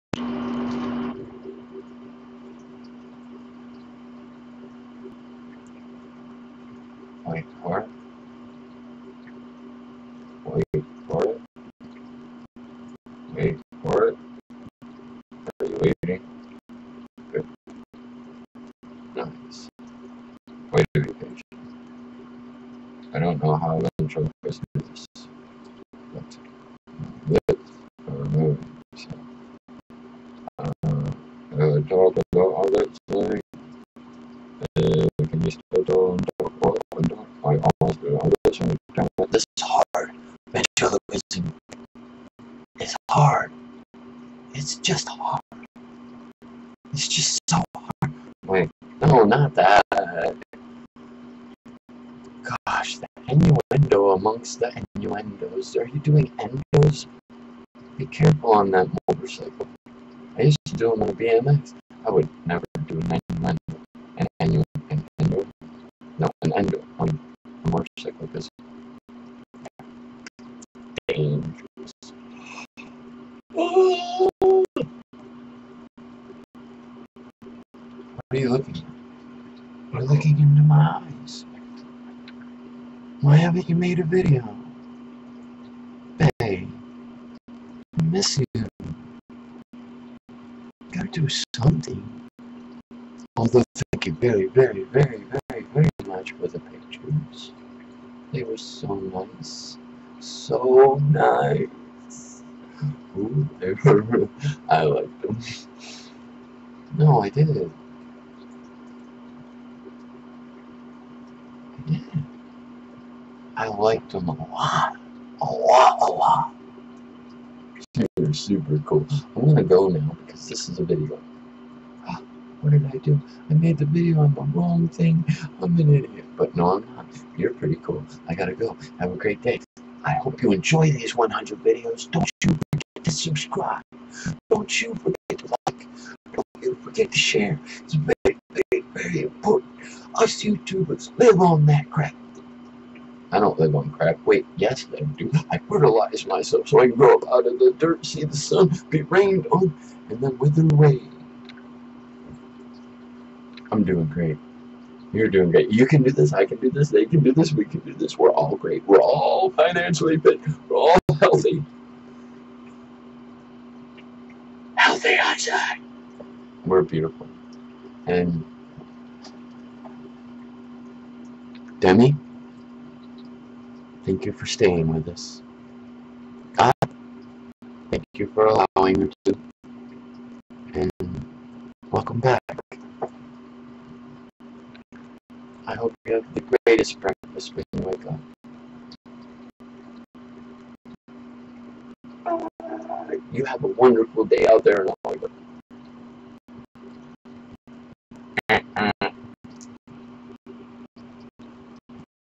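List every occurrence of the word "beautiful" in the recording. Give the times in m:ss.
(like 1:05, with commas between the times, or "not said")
2:46.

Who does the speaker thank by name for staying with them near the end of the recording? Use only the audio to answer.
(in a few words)
Demi.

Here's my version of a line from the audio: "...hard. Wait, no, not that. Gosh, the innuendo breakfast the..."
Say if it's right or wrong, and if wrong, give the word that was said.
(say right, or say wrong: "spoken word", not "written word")
wrong: "amongst", not "breakfast".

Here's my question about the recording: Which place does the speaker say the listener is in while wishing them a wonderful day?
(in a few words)
Hollywood.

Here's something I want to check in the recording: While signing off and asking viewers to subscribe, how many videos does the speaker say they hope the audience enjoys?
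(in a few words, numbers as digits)
100.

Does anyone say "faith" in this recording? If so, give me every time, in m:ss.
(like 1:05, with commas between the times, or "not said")
not said.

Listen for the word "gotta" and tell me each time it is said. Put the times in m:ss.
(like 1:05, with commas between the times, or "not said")
1:30, 2:08.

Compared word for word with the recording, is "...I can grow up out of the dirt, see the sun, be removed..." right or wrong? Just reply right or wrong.
wrong.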